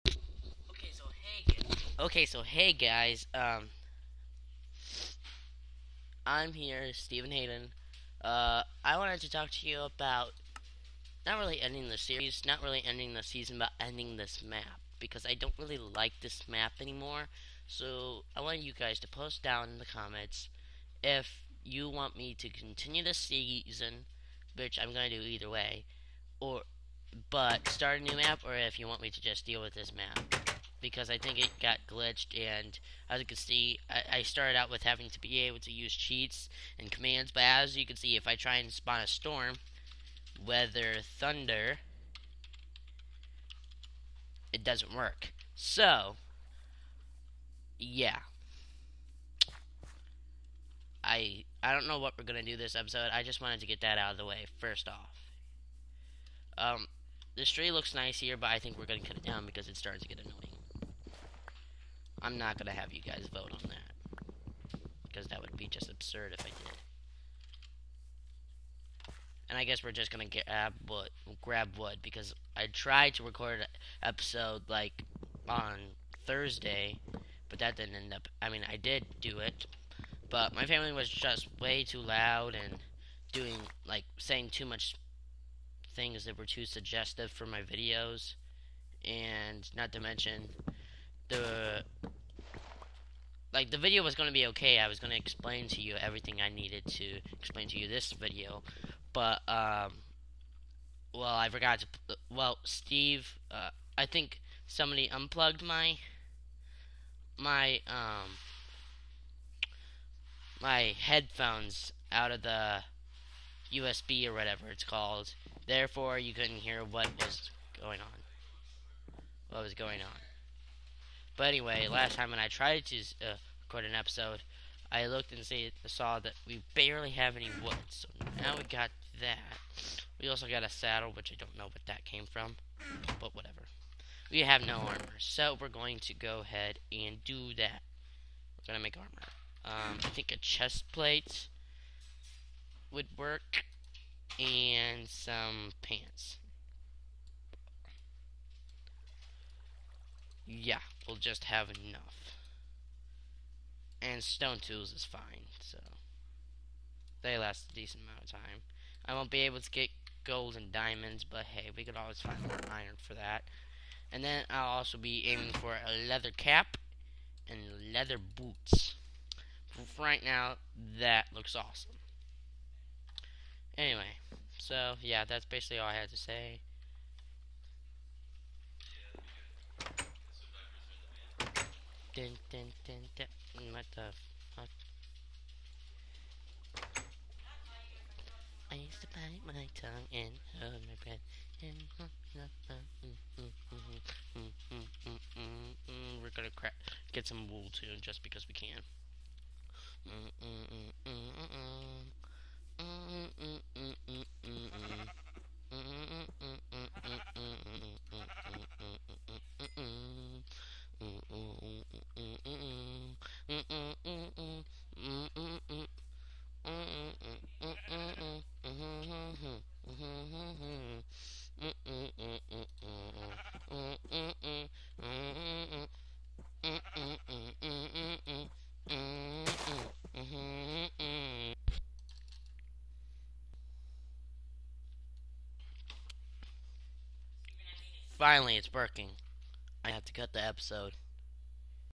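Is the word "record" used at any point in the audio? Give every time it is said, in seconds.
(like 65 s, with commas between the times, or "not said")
73 s, 123 s.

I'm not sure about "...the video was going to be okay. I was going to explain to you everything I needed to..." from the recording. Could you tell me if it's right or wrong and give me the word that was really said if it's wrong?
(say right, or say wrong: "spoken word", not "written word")
right.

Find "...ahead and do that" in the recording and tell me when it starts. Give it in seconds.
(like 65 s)
136 s.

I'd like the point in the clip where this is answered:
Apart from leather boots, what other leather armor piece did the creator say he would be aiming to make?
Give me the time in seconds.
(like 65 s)
166 s.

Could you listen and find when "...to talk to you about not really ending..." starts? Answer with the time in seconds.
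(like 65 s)
9 s.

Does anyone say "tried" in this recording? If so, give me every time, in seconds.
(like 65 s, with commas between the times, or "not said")
72 s, 122 s.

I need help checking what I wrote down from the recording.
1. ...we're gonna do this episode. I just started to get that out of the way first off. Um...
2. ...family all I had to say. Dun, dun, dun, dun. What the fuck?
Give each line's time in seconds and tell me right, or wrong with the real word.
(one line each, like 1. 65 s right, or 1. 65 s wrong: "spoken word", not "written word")
1. 52 s wrong: "wanted", not "started"
2. 175 s wrong: "basically", not "family".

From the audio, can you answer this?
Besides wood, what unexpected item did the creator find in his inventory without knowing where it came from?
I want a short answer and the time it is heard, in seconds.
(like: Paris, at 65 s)
A saddle, at 130 s.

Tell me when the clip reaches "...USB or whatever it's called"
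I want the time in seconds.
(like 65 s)
113 s.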